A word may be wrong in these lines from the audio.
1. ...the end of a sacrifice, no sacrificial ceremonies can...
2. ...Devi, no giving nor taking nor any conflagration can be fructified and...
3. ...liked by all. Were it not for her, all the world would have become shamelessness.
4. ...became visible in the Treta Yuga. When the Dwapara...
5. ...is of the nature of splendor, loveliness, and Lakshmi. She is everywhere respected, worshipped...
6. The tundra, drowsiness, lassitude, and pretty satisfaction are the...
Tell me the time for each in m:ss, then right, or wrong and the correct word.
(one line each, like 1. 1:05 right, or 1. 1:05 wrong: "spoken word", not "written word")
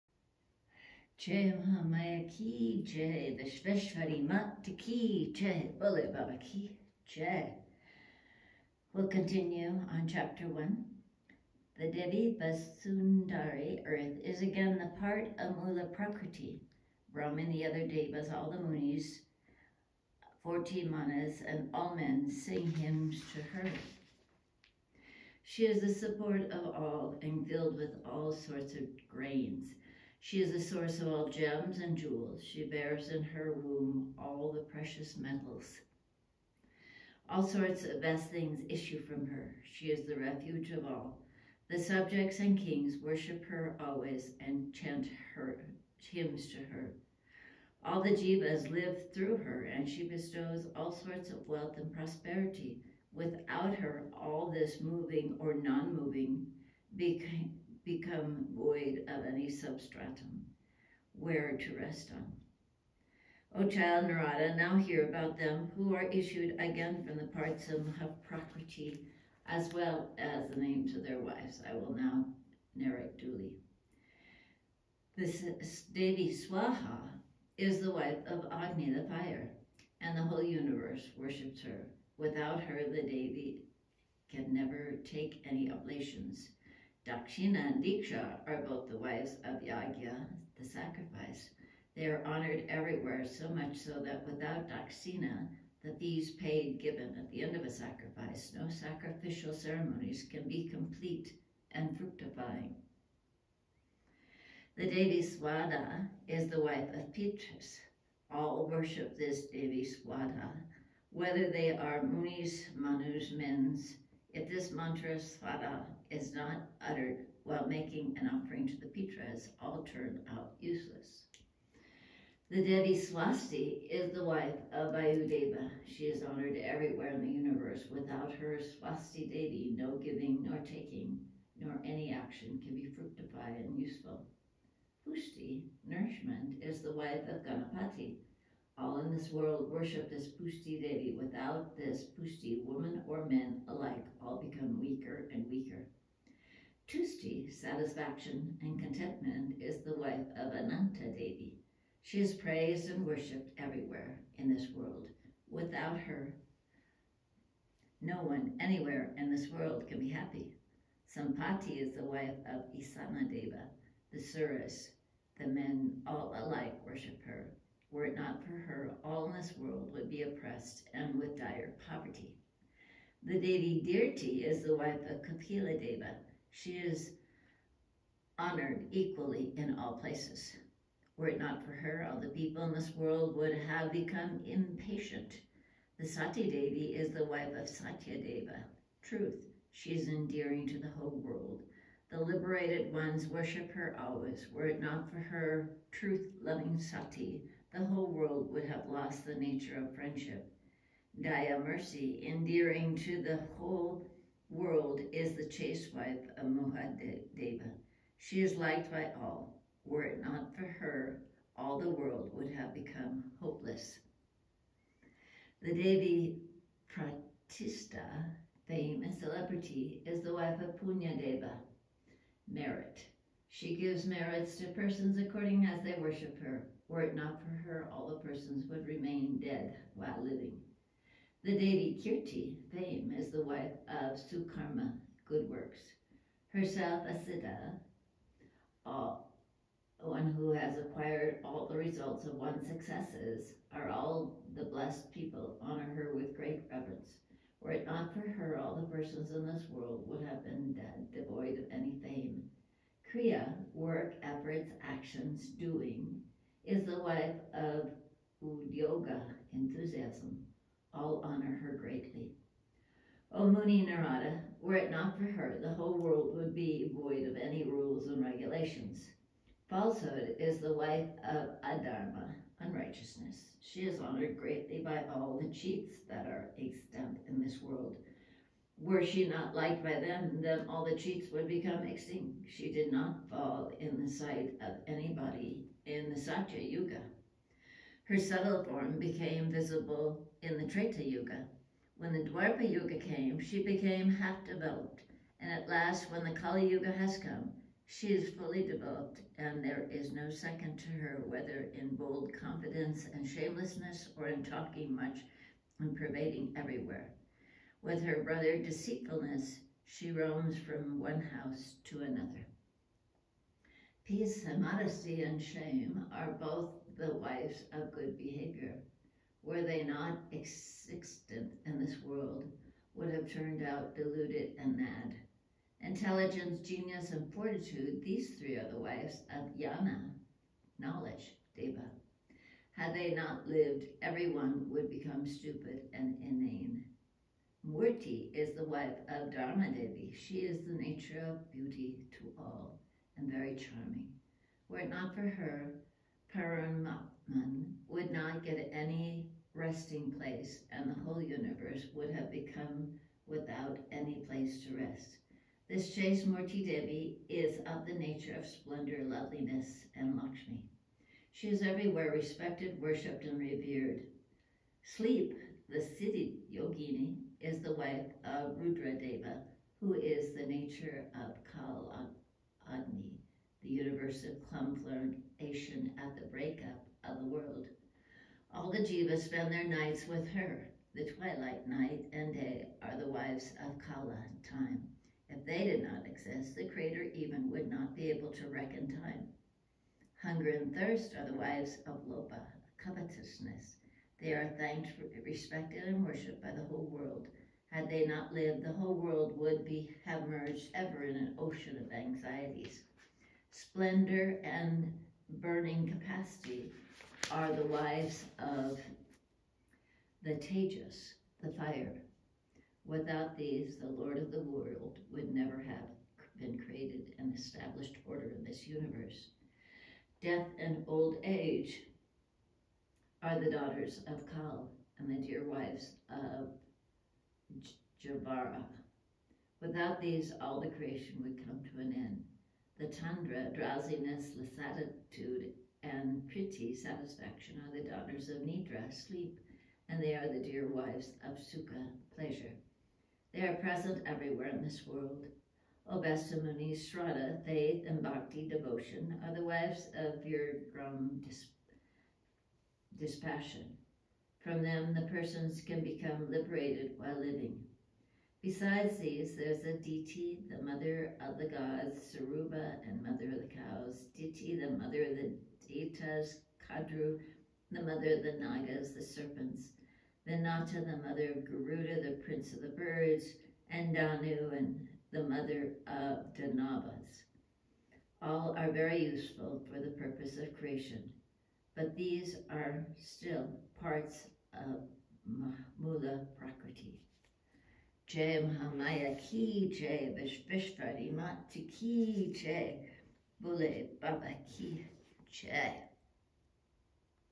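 1. 1:37 right
2. 2:09 wrong: "action", not "conflagration"
3. 3:28 wrong: "hopeless", not "shamelessness"
4. 4:48 right
5. 5:57 right
6. 7:12 right.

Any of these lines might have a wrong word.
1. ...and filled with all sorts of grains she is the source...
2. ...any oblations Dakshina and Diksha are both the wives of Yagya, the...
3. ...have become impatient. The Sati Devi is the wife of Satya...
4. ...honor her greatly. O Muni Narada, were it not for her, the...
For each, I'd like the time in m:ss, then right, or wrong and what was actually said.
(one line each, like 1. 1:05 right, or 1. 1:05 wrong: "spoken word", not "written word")
1. 0:27 right
2. 1:25 right
3. 3:03 right
4. 4:21 right.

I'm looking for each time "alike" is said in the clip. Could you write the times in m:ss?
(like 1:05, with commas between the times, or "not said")
2:23, 2:46.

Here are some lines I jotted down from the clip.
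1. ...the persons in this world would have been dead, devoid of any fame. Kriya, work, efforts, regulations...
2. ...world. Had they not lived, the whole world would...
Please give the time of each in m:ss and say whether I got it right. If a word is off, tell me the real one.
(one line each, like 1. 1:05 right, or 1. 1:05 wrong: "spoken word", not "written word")
1. 4:08 wrong: "actions", not "regulations"
2. 6:36 right.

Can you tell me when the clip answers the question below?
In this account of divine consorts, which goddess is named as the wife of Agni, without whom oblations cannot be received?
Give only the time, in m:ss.
1:15.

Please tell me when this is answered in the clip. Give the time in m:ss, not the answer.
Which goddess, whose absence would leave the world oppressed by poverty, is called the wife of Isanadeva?
2:41.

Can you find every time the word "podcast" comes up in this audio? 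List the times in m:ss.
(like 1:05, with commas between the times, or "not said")
not said.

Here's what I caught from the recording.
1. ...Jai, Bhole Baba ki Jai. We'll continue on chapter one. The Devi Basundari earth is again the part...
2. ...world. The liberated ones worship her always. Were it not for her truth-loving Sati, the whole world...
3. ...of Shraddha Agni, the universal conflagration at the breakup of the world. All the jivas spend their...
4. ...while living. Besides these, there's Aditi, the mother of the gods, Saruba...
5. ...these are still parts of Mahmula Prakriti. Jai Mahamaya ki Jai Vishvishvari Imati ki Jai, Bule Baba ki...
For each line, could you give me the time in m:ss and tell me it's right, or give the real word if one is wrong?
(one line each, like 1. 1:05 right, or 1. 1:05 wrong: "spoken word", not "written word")
1. 0:05 right
2. 3:11 right
3. 6:11 wrong: "Kal", not "Shraddha"
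4. 7:36 right
5. 8:01 right.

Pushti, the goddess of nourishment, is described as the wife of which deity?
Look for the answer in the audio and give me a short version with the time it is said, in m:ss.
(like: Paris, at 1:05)
Ganapati, at 2:17.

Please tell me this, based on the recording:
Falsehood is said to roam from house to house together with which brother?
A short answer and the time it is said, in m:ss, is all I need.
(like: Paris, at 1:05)
Deceitfulness, at 5:08.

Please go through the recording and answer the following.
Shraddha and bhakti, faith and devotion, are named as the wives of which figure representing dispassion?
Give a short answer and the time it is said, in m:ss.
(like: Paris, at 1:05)
Virgram, at 7:30.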